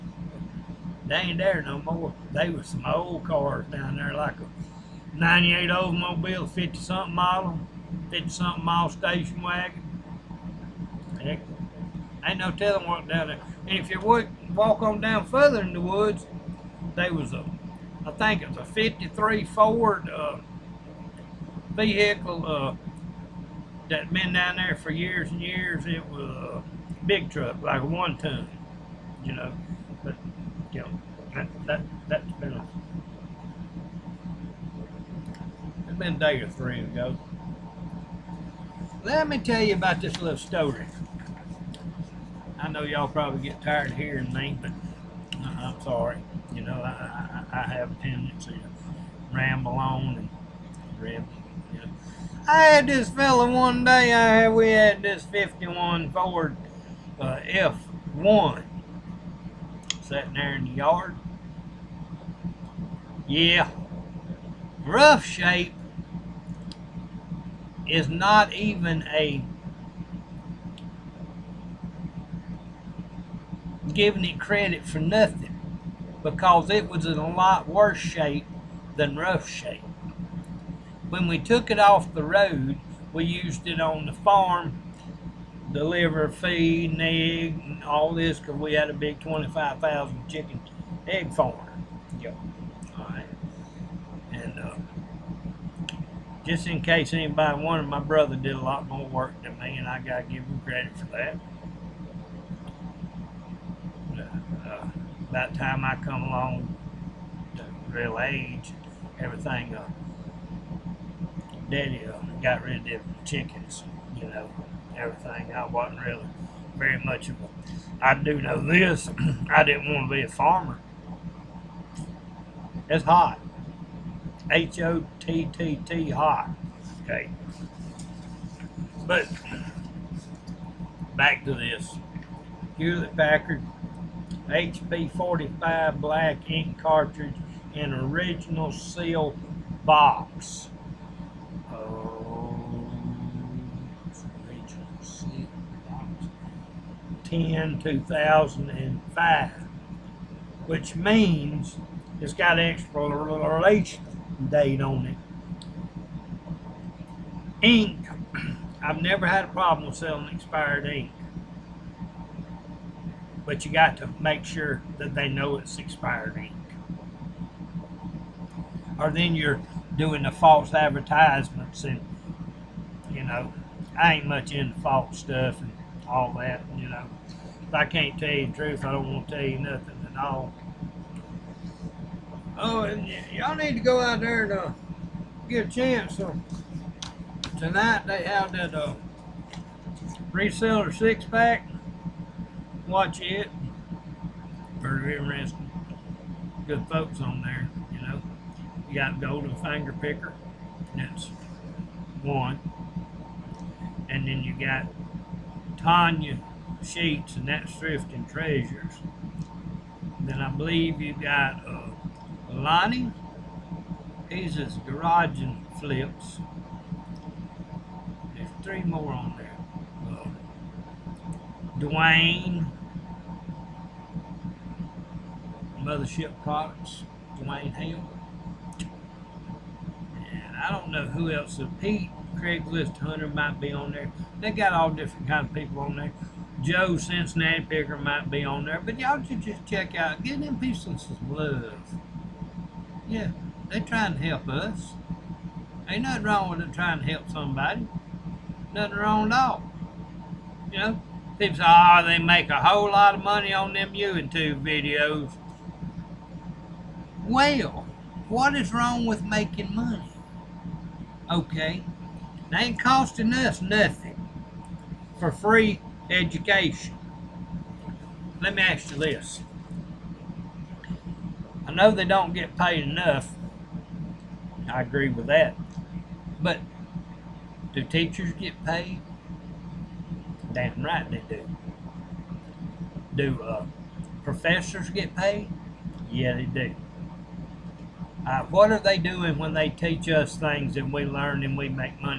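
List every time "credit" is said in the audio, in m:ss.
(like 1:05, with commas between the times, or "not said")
1:14, 1:40.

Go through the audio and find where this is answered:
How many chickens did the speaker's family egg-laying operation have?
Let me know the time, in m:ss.
1:29.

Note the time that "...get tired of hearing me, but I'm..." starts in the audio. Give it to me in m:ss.
0:43.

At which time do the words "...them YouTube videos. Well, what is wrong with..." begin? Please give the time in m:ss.
4:13.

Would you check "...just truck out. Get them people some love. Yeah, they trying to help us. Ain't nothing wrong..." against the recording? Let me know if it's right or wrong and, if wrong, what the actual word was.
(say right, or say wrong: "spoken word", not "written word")
wrong: "check", not "truck".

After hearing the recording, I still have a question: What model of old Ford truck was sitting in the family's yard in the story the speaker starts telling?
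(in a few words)
51 Ford F1.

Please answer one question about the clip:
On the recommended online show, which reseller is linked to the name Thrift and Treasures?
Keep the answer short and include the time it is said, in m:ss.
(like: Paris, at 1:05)
Tanya Sheets, at 3:25.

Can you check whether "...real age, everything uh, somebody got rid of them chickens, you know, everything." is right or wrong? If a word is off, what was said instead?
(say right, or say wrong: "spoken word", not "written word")
wrong: "daddy", not "somebody".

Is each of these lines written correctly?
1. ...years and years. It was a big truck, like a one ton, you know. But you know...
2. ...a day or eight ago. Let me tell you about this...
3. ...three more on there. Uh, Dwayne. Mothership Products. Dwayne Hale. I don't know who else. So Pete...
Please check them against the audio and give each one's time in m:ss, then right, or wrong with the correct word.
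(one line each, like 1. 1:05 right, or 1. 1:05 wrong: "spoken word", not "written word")
1. 0:24 right
2. 0:36 wrong: "three", not "eight"
3. 3:38 right.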